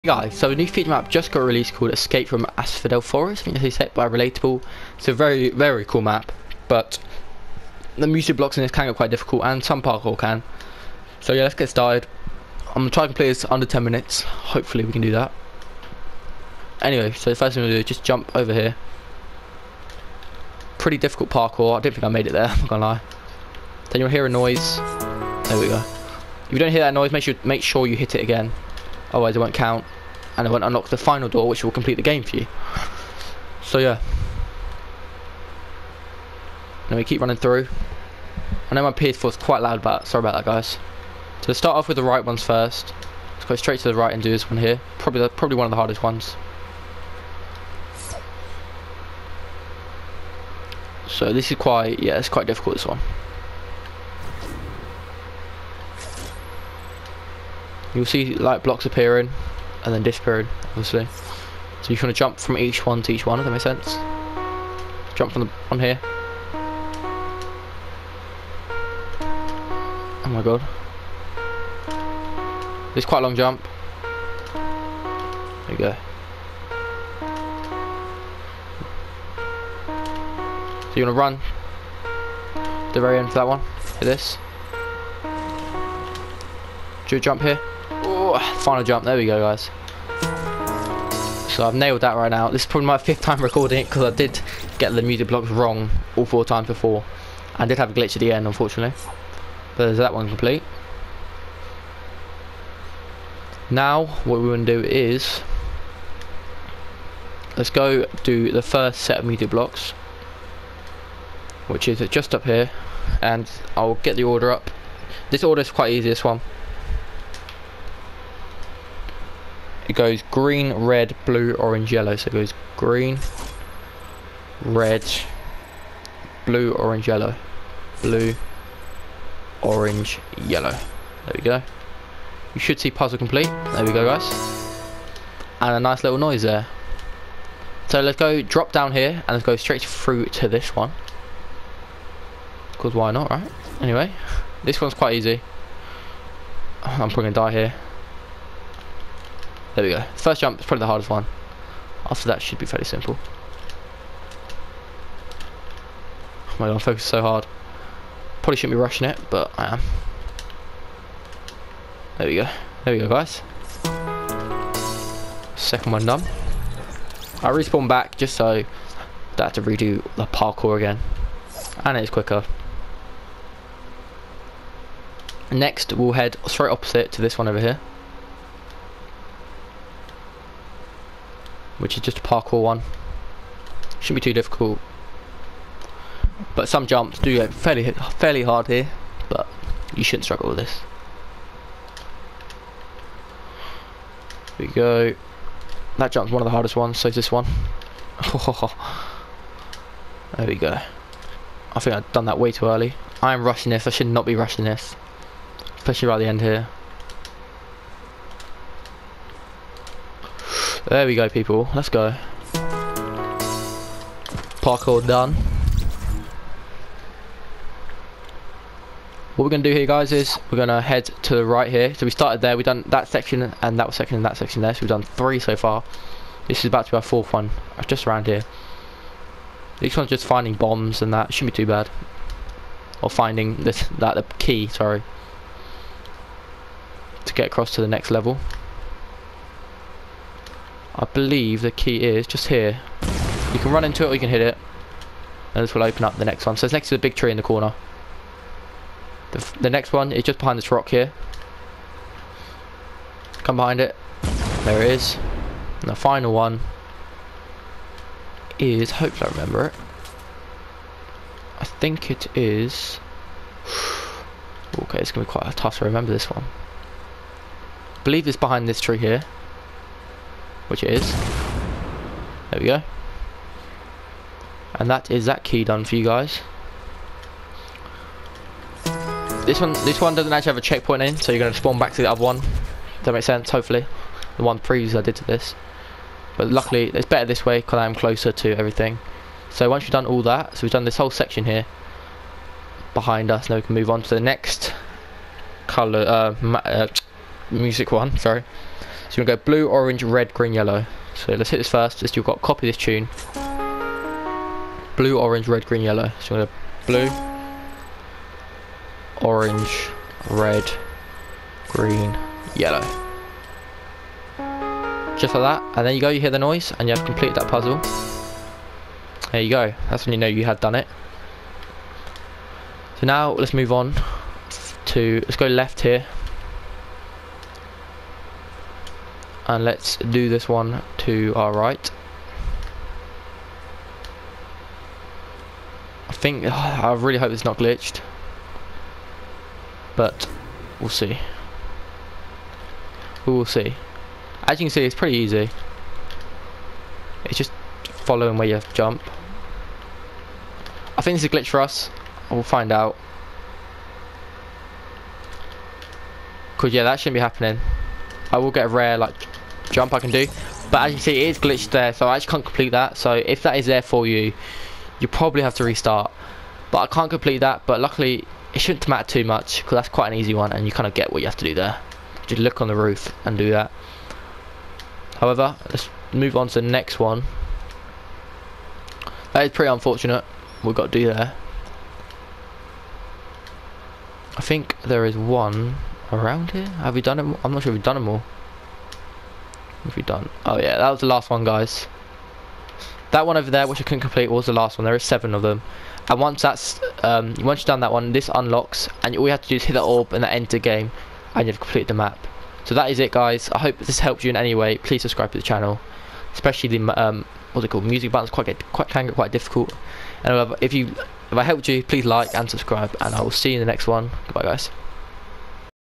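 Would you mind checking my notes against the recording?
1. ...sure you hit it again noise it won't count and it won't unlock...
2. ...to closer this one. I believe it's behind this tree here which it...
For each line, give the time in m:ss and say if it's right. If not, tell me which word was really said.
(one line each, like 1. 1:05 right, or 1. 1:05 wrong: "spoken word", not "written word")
1. 0:27 wrong: "otherwise", not "noise"
2. 4:25 wrong: "remember", not "closer".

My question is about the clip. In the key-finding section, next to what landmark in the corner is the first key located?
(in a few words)
big tree.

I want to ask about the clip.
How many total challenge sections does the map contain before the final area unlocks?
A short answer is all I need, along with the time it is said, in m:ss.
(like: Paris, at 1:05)
7, at 6:34.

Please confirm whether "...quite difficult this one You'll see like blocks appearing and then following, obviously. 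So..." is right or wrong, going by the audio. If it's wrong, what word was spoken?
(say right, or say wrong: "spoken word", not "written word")
wrong: "disappearing", not "following".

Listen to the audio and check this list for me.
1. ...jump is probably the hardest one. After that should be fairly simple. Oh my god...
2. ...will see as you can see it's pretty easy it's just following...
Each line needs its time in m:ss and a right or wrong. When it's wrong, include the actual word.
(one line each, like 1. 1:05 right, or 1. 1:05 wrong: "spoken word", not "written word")
1. 2:30 right
2. 5:43 right.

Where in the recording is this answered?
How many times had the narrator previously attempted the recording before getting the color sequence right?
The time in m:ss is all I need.
1:36.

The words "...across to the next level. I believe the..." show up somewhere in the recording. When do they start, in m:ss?
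3:57.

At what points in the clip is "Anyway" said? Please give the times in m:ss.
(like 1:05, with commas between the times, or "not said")
0:16, 2:23.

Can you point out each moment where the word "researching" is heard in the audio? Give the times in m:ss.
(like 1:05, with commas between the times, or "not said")
not said.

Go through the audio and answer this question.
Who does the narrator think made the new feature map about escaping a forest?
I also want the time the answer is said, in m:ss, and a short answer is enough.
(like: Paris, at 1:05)
Relatable, at 0:04.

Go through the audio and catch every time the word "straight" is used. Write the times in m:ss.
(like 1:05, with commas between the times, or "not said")
0:43, 2:19, 2:56.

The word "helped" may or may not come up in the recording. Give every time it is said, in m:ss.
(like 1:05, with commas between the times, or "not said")
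6:43, 6:51.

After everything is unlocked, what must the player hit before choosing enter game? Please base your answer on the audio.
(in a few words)
the orb.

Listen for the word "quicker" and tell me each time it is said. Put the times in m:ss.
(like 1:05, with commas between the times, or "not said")
2:52.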